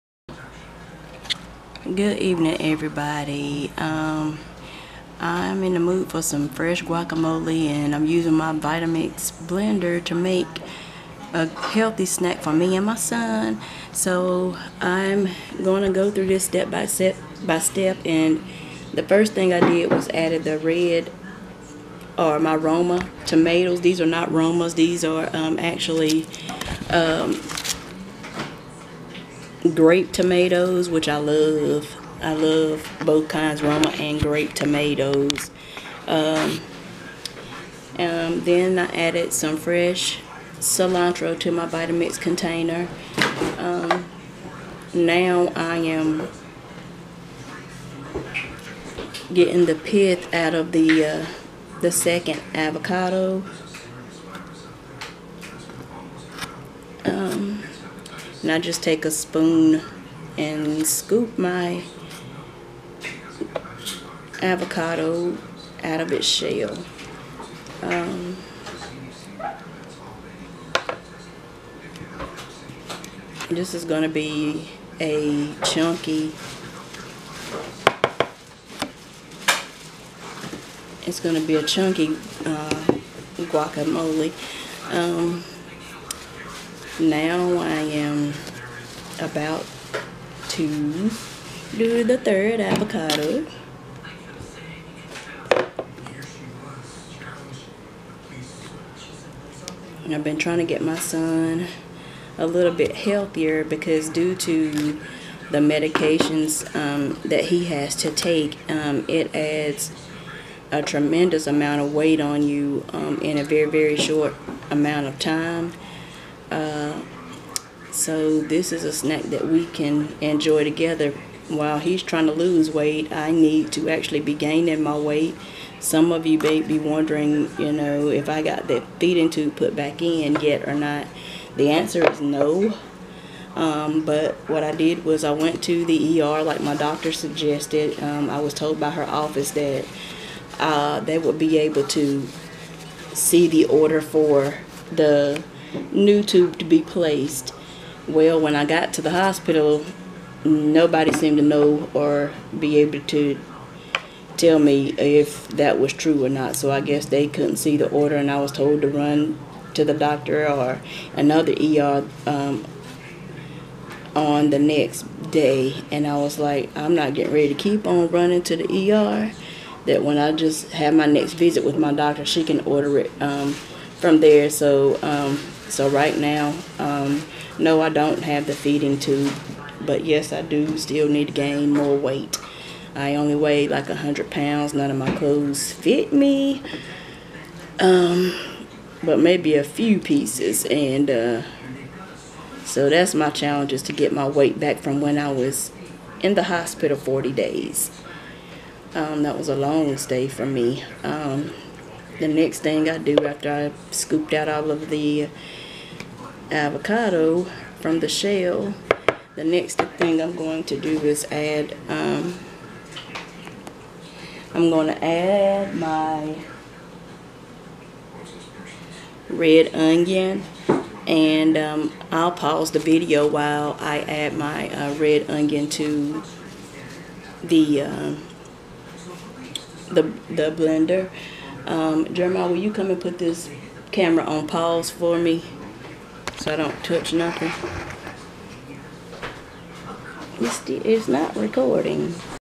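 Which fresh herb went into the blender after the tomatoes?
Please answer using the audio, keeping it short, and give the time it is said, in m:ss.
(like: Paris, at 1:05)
cilantro, at 0:40.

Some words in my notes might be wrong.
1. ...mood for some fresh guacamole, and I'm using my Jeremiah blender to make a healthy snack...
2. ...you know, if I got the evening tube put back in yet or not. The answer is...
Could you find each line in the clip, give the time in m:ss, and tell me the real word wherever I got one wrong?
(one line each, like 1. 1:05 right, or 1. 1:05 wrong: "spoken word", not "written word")
1. 0:05 wrong: "Vitamix", not "Jeremiah"
2. 2:07 wrong: "feeding", not "evening".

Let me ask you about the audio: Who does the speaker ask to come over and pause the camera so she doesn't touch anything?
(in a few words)
Jeremiah.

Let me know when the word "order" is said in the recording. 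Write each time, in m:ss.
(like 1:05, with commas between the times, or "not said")
2:23, 2:37, 2:52.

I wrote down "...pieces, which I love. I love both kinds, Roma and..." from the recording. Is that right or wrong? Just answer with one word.
wrong.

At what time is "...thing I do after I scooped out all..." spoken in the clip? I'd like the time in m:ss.
3:22.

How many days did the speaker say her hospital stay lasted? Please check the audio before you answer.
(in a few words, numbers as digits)
40.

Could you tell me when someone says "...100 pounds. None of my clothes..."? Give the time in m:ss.
3:03.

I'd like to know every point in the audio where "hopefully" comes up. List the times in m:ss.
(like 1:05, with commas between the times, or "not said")
not said.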